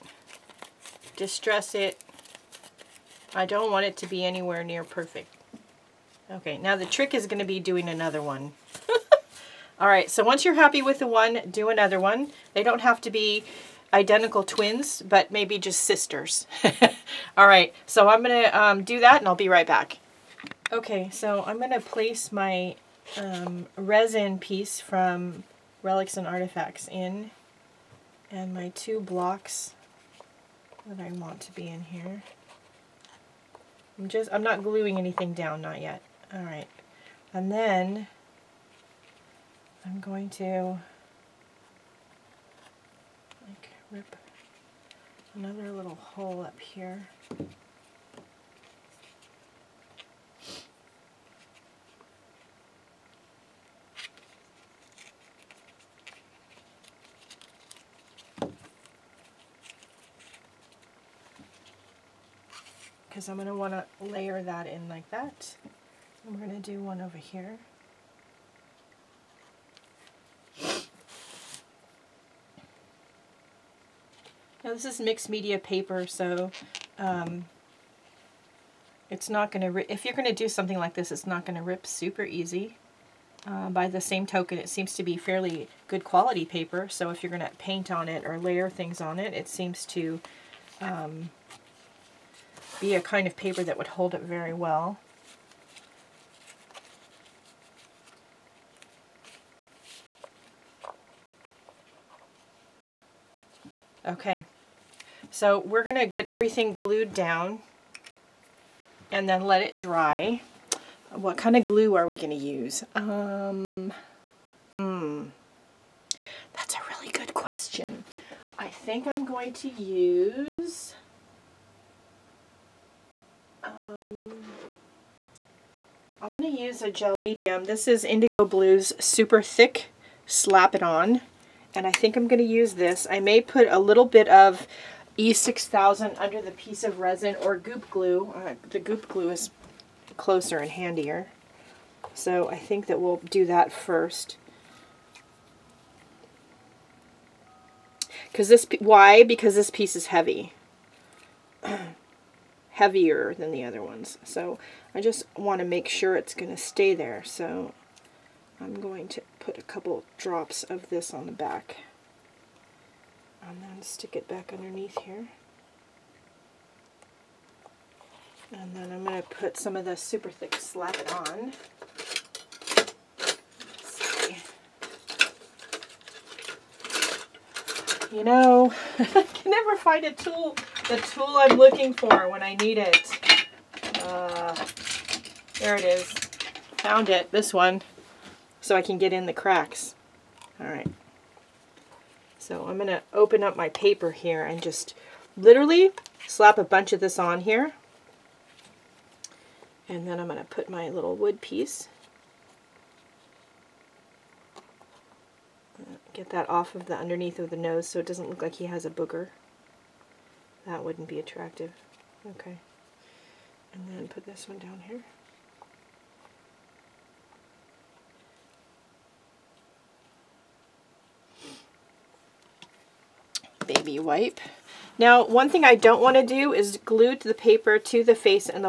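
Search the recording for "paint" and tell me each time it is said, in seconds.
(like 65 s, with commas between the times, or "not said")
87 s.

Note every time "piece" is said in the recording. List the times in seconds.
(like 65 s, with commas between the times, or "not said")
24 s, 136 s, 149 s, 201 s.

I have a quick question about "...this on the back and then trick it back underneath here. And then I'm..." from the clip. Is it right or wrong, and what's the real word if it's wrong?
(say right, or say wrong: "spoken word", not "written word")
wrong: "stick", not "trick".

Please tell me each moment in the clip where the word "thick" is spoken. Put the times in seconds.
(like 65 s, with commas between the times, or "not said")
129 s, 170 s.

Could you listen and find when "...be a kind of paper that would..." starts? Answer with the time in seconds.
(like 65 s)
92 s.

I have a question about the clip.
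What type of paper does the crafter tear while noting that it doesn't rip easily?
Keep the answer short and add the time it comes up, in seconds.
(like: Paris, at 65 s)
Mixed media paper, at 74 s.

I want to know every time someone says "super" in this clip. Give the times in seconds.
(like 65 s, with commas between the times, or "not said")
81 s, 129 s, 169 s.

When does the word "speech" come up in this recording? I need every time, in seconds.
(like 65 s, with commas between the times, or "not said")
not said.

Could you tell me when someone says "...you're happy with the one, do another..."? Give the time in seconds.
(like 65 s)
10 s.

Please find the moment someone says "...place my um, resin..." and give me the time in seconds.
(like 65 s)
21 s.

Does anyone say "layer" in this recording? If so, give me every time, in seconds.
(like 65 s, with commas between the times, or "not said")
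64 s, 88 s.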